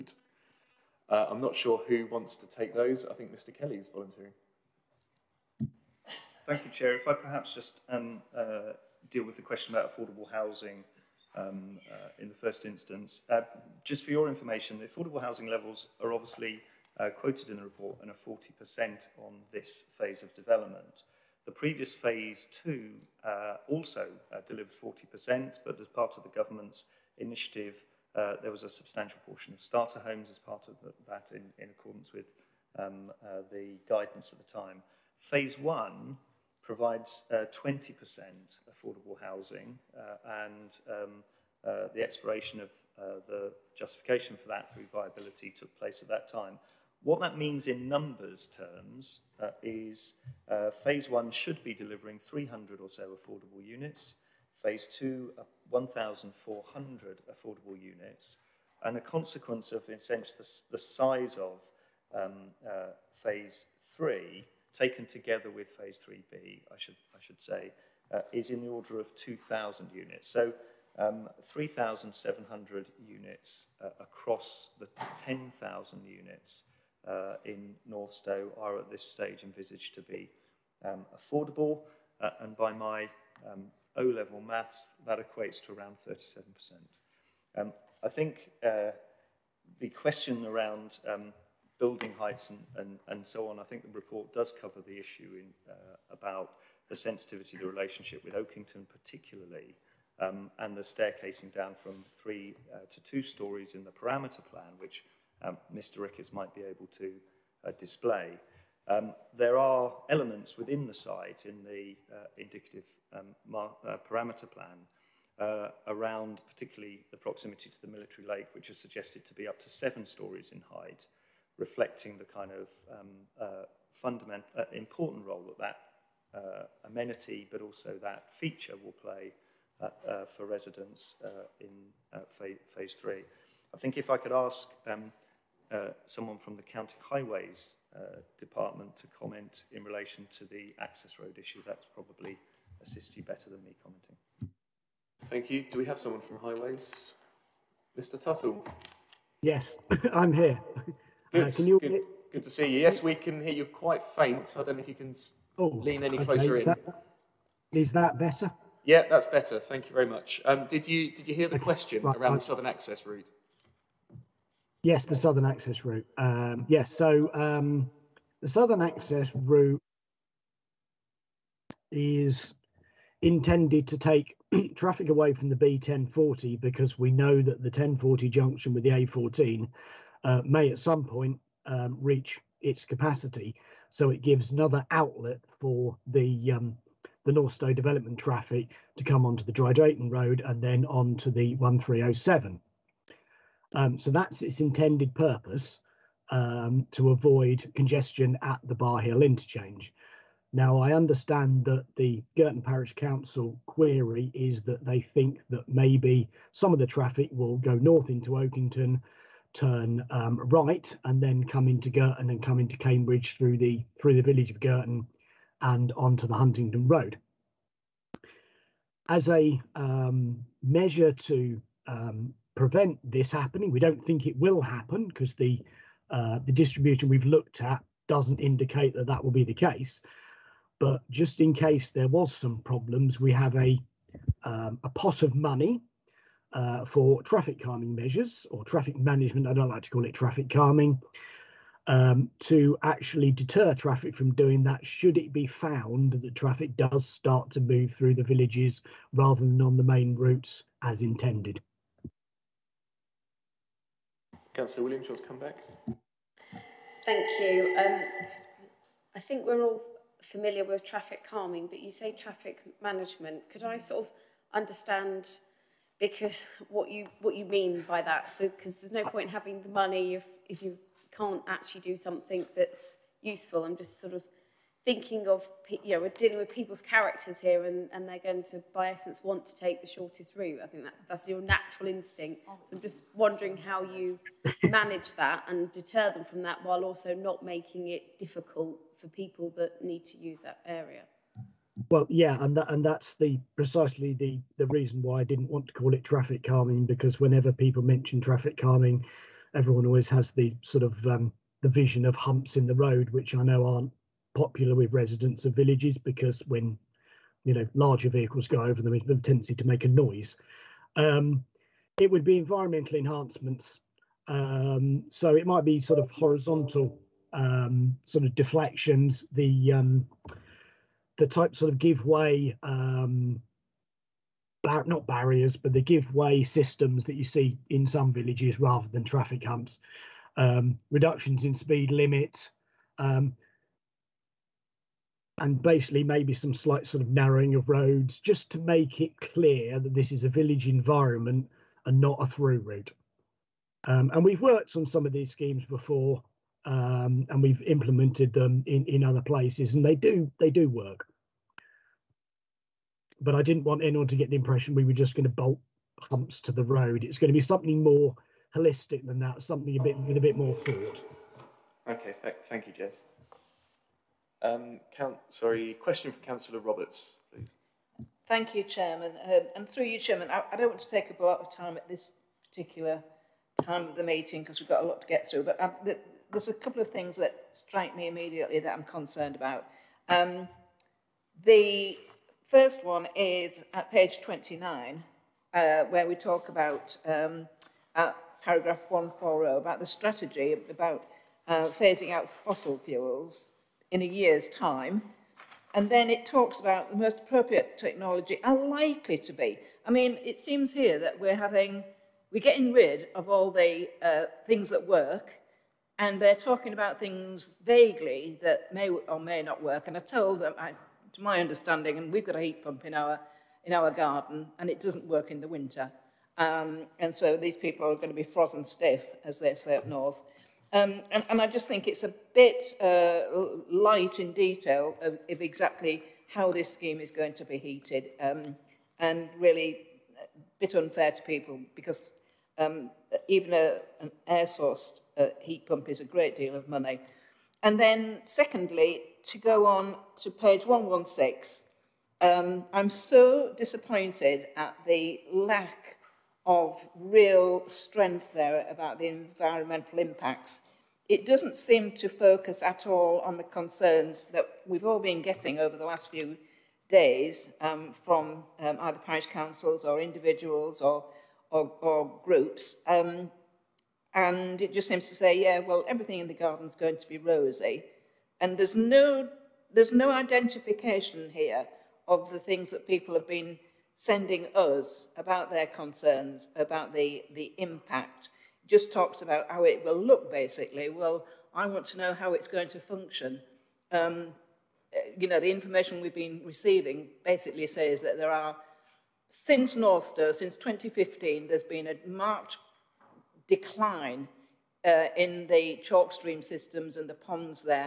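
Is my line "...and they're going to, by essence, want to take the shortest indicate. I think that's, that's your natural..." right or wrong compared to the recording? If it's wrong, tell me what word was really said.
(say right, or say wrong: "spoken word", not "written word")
wrong: "route", not "indicate".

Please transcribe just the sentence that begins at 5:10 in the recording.
Um, it would be environmental enhancements.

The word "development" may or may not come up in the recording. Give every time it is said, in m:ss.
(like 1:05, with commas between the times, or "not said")
0:20, 3:07.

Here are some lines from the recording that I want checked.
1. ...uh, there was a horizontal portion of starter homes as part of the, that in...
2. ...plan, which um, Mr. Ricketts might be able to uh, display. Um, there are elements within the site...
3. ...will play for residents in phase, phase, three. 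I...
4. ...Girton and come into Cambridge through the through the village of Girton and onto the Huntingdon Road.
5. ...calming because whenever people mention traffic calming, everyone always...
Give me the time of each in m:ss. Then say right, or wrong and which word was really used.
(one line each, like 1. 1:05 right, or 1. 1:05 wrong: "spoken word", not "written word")
1. 0:28 wrong: "substantial", not "horizontal"
2. 1:44 right
3. 2:08 right
4. 3:31 right
5. 4:56 right.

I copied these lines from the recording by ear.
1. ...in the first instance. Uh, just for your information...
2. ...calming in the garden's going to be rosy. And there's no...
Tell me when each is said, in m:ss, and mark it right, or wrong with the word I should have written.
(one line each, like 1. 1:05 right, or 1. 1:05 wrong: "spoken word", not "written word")
1. 0:12 right
2. 7:45 wrong: "everything", not "calming".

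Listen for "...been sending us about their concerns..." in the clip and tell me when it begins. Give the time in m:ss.
7:53.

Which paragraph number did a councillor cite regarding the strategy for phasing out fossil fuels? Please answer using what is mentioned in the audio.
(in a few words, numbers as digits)
140.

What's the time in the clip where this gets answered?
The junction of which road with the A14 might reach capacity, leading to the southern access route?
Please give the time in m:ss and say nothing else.
2:55.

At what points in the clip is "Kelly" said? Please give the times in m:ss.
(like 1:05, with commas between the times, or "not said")
0:03.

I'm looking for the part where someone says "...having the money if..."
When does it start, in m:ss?
4:29.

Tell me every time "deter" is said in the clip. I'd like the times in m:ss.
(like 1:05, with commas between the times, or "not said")
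4:03, 4:45.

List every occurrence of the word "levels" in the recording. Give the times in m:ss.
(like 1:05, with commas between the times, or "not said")
0:15, 1:23.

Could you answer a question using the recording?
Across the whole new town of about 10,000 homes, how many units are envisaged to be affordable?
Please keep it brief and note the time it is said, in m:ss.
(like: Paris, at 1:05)
3,700, at 1:11.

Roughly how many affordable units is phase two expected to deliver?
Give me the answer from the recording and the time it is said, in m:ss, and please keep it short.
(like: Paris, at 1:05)
1,400, at 0:55.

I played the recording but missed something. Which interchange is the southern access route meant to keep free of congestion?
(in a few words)
Bar Hill interchange.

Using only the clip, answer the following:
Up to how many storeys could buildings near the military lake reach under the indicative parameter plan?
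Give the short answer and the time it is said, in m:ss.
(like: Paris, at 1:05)
7, at 1:59.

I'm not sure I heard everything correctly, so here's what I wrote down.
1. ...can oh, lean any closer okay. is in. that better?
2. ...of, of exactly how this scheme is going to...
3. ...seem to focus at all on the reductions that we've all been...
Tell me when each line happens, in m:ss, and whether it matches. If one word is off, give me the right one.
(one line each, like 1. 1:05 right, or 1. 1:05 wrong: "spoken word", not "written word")
1. 2:34 right
2. 7:05 right
3. 7:31 wrong: "concerns", not "reductions".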